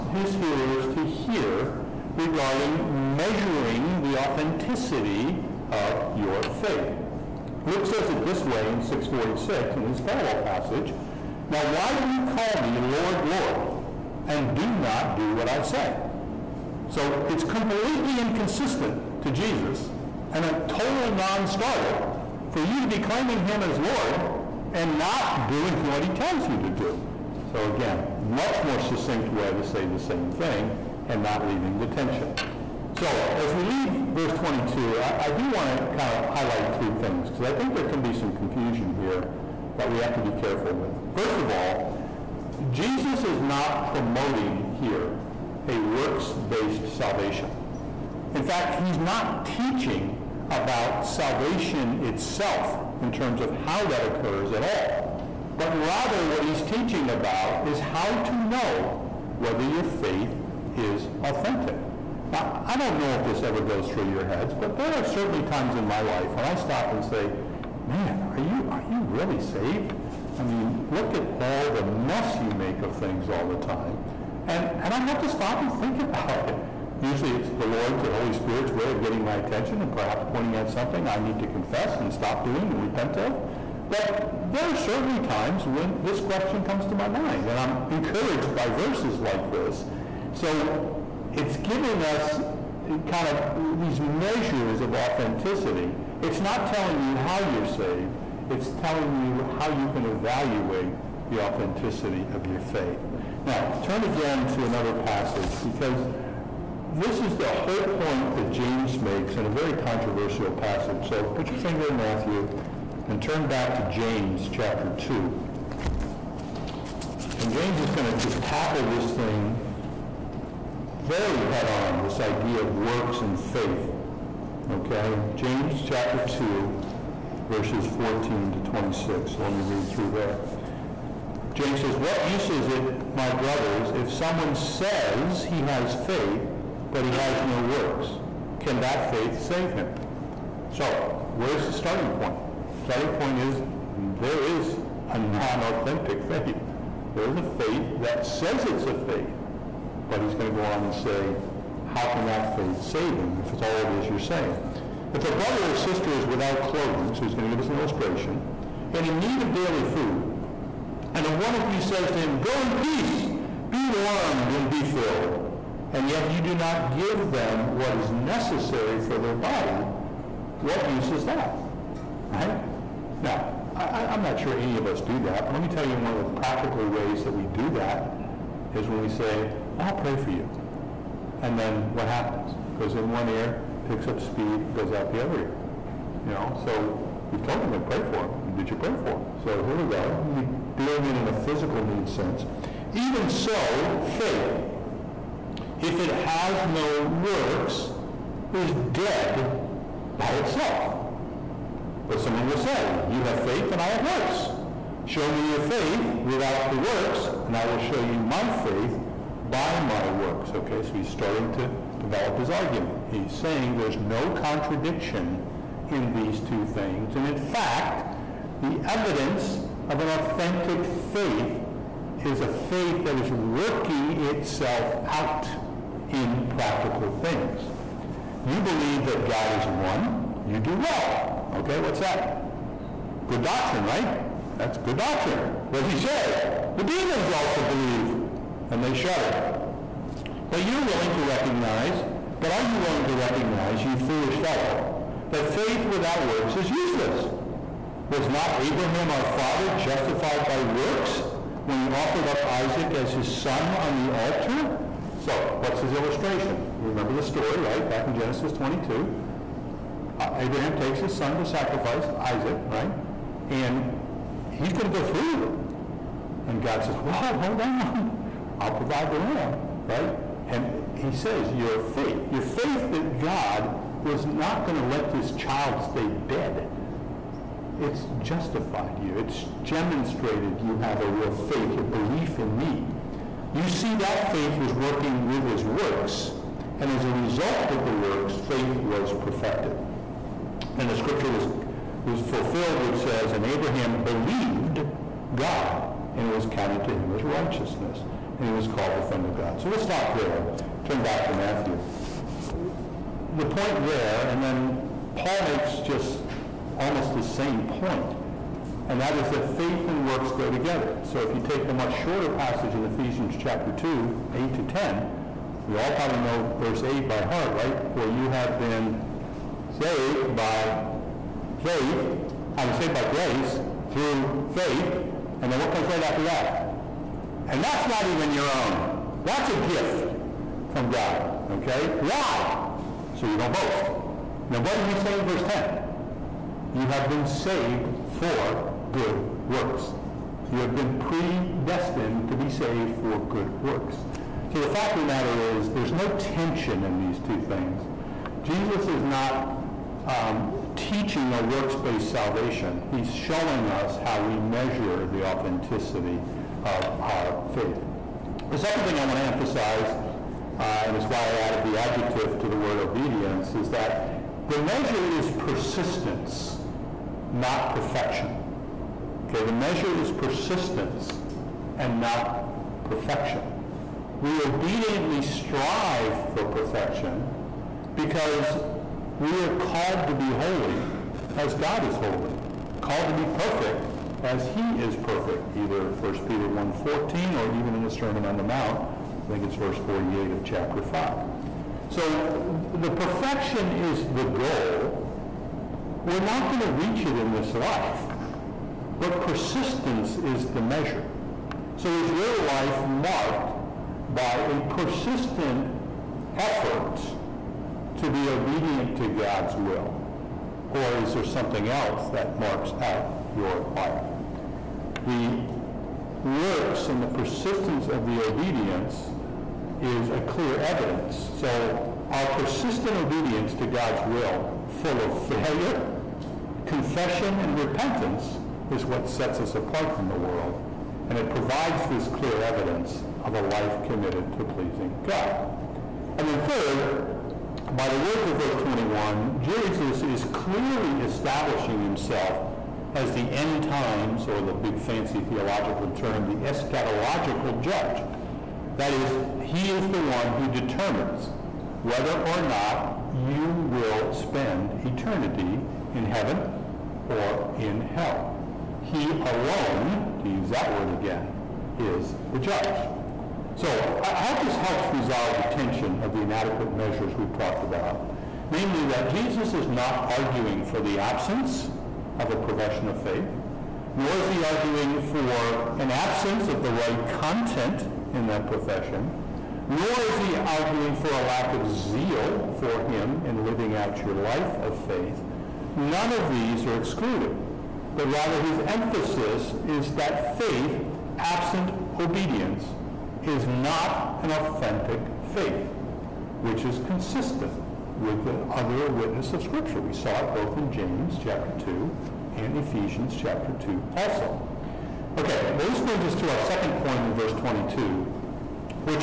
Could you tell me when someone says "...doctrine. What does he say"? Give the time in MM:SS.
03:54.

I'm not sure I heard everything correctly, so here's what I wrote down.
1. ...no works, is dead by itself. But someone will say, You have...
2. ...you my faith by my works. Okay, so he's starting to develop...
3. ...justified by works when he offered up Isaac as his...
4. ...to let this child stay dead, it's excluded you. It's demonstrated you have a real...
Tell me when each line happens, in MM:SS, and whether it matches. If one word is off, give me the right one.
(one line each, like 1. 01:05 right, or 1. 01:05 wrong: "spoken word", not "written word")
1. 03:16 right
2. 03:28 right
3. 04:09 right
4. 04:34 wrong: "justified", not "excluded".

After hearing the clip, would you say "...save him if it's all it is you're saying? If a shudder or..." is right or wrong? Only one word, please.
wrong.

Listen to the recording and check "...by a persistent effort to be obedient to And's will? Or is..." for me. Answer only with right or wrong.
wrong.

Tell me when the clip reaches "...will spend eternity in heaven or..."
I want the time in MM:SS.
07:33.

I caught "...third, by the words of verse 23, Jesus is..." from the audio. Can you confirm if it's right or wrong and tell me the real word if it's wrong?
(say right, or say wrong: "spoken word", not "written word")
wrong: "21", not "23".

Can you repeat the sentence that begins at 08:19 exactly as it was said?
We saw it both in James chapter 2 and Ephesians chapter 2 also.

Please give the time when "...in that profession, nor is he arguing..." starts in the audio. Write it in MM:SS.
07:58.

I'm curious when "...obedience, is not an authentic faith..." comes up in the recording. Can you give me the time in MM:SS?
08:11.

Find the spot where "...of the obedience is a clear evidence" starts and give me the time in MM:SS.
06:57.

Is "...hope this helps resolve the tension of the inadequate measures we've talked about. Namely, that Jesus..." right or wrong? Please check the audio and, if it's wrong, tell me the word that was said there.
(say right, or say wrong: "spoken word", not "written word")
right.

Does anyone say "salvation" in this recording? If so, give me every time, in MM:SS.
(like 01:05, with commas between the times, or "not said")
00:46, 00:51, 05:52.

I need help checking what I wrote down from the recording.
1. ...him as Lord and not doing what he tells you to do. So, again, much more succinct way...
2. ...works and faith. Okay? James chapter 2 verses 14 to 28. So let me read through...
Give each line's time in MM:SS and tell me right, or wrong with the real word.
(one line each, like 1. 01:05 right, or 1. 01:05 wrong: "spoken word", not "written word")
1. 00:23 right
2. 02:02 wrong: "26", not "28".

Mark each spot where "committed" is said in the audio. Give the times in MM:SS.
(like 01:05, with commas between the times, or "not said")
07:13.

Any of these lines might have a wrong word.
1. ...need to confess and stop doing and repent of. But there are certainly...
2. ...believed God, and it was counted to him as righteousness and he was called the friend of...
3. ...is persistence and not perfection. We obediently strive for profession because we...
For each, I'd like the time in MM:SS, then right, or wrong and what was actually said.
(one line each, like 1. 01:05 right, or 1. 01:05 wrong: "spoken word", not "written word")
1. 01:21 right
2. 04:54 right
3. 06:09 wrong: "perfection", not "profession".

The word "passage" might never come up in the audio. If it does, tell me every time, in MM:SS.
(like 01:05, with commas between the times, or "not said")
00:10, 01:44, 01:50, 05:12.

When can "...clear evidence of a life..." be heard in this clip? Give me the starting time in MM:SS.
07:12.